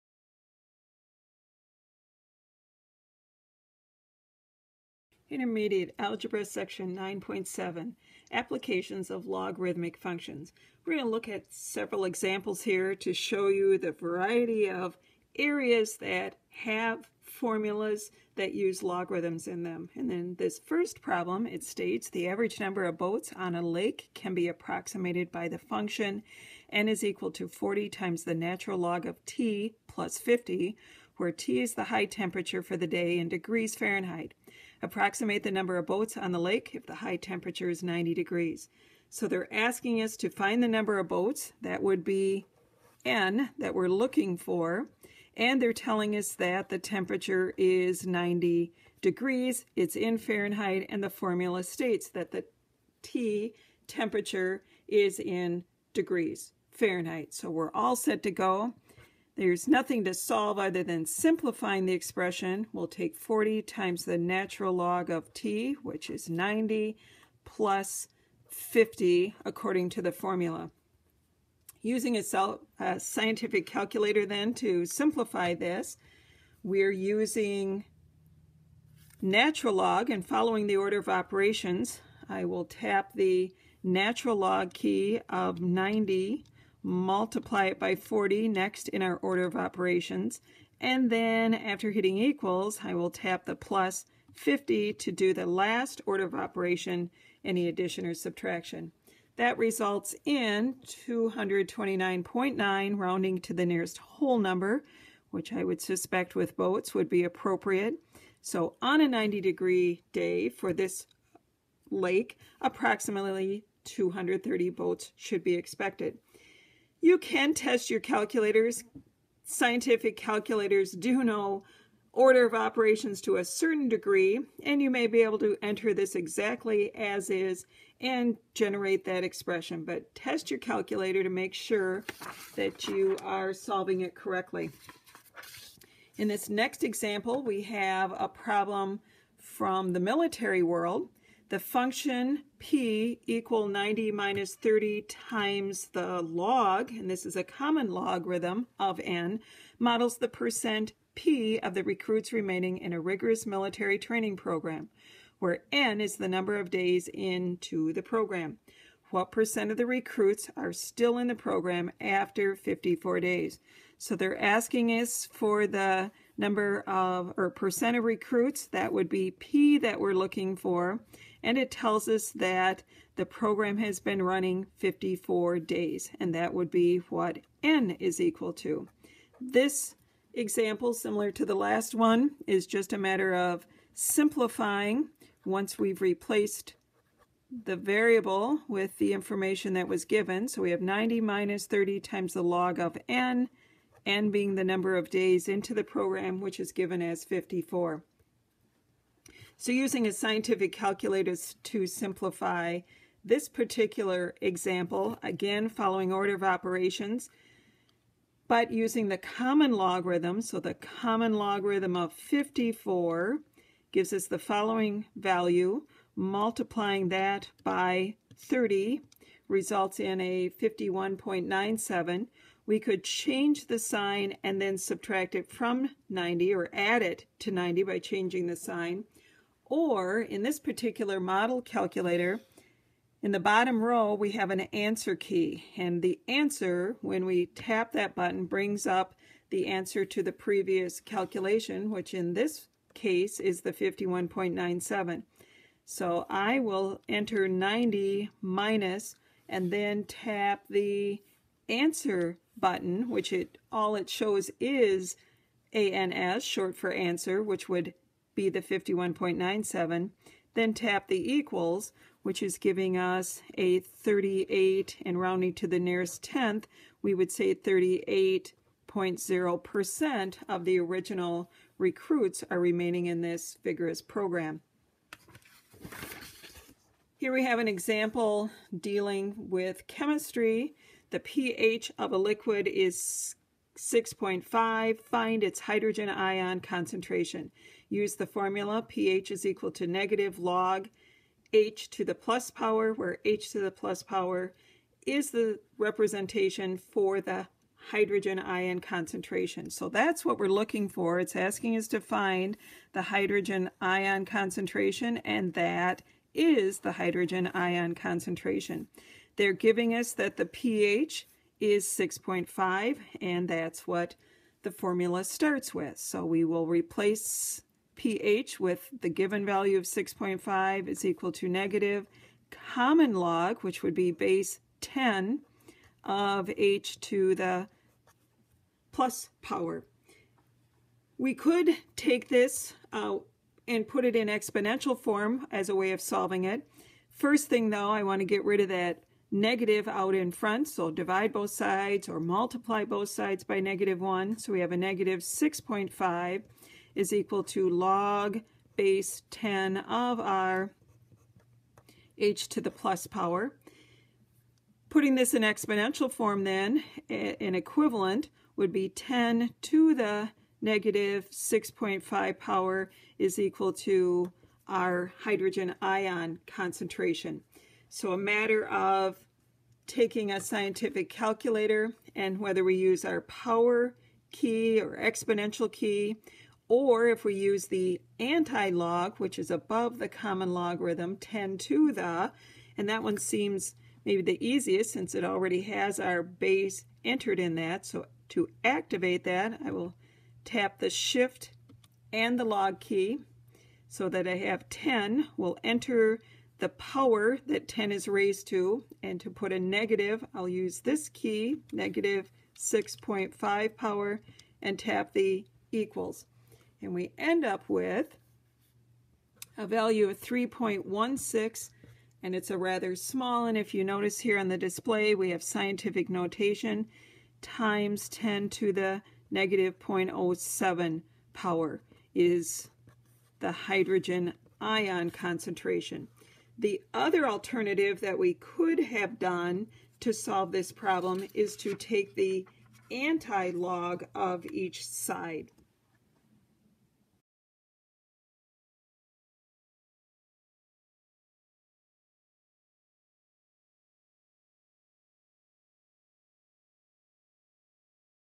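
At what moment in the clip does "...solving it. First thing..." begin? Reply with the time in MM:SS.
05:36.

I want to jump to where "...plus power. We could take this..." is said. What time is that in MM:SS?
05:28.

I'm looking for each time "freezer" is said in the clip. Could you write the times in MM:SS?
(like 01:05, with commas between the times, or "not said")
not said.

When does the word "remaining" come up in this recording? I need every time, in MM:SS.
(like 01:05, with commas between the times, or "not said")
02:32, 04:32.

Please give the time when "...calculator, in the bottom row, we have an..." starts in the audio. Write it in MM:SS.
03:51.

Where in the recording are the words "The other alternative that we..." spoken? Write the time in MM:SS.
07:06.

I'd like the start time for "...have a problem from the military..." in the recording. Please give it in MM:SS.
02:17.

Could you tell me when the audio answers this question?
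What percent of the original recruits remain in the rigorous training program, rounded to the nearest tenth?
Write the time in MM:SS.
04:27.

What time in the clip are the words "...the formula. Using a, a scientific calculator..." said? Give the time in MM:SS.
01:10.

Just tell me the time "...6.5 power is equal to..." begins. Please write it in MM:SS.
06:01.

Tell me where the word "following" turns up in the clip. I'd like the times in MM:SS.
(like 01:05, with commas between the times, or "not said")
01:20, 03:25, 03:34.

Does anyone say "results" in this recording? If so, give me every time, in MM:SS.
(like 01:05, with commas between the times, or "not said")
01:39, 03:39.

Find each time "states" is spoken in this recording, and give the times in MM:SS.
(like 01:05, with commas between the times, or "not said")
00:21, 00:51.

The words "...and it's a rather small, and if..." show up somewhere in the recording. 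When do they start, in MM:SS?
06:52.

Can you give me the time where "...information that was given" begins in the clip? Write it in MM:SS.
03:09.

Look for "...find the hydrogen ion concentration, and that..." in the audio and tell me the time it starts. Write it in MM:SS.
05:01.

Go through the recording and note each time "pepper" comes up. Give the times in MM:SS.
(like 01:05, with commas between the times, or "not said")
not said.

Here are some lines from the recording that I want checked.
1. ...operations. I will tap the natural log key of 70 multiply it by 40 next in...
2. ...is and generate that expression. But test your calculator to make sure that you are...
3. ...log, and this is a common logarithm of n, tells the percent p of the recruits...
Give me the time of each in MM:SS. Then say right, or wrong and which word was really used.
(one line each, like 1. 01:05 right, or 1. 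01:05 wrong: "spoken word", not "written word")
1. 01:21 wrong: "90", not "70"
2. 02:07 right
3. 02:26 wrong: "models", not "tells".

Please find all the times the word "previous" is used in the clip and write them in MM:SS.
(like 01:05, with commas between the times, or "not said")
04:00.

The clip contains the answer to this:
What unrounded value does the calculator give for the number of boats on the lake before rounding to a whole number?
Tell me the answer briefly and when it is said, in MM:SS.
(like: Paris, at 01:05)
229.9, at 01:41.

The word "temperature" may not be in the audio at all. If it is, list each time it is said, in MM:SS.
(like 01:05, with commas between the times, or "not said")
00:32, 00:37, 00:46, 00:53.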